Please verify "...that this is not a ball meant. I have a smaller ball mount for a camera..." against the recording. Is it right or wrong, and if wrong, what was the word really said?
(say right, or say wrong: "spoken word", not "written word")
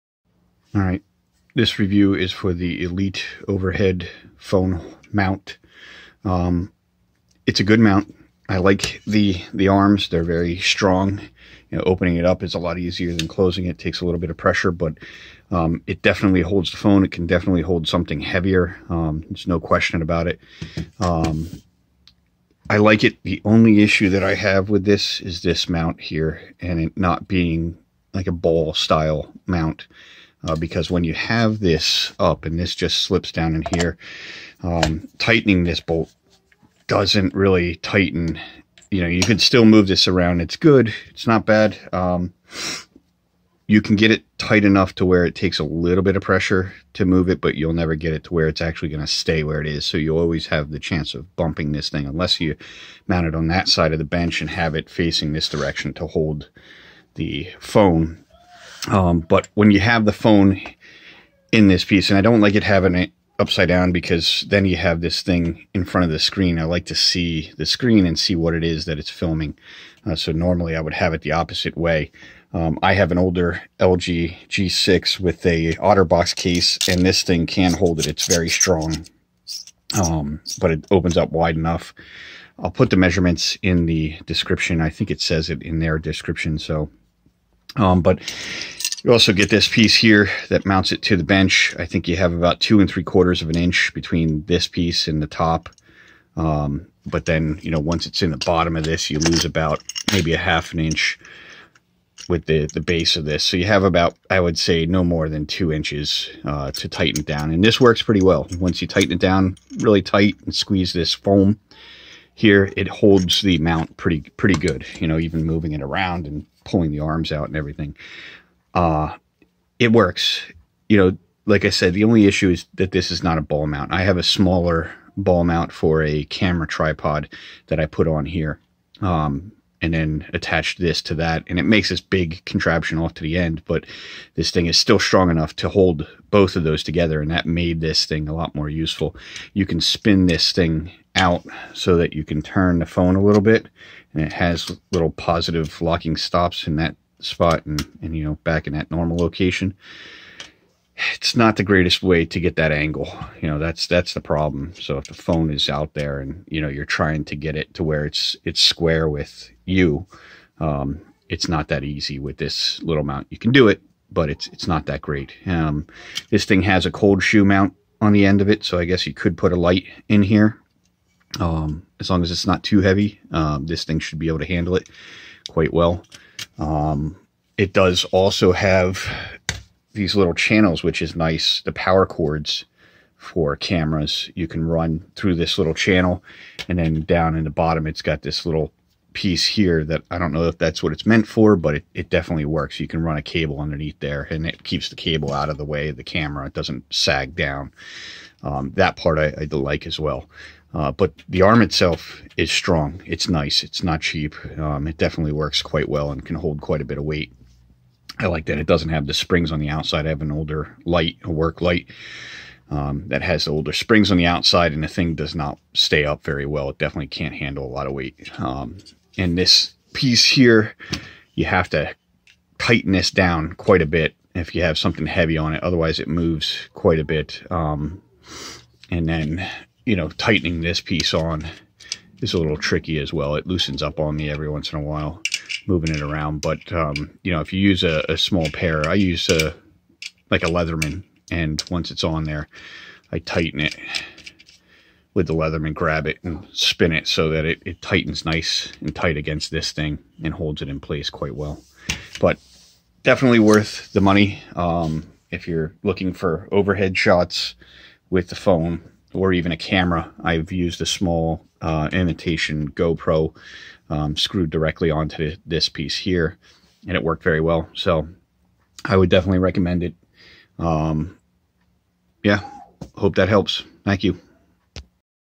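wrong: "mount", not "meant".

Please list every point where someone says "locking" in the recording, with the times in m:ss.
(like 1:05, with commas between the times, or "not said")
2:25.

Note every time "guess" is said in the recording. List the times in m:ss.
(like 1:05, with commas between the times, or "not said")
2:48.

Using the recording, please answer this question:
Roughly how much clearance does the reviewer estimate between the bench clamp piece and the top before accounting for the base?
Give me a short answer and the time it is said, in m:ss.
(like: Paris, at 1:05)
2 3/4 inches, at 1:32.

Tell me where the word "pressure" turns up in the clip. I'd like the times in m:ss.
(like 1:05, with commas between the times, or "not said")
0:14, 0:46.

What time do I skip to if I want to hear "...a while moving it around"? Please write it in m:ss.
3:54.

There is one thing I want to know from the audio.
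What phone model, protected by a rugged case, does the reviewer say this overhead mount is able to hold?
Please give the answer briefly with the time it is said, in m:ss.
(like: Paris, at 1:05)
LG G6, at 1:13.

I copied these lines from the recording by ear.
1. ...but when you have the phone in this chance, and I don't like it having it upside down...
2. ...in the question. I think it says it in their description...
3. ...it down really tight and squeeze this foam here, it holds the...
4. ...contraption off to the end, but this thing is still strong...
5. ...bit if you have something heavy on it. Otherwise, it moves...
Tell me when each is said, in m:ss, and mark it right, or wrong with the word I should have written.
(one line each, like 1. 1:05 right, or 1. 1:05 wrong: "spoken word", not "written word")
1. 0:59 wrong: "piece", not "chance"
2. 1:23 wrong: "description", not "question"
3. 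1:49 right
4. 2:12 right
5. 3:43 right.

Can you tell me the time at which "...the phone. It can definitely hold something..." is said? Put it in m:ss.
0:16.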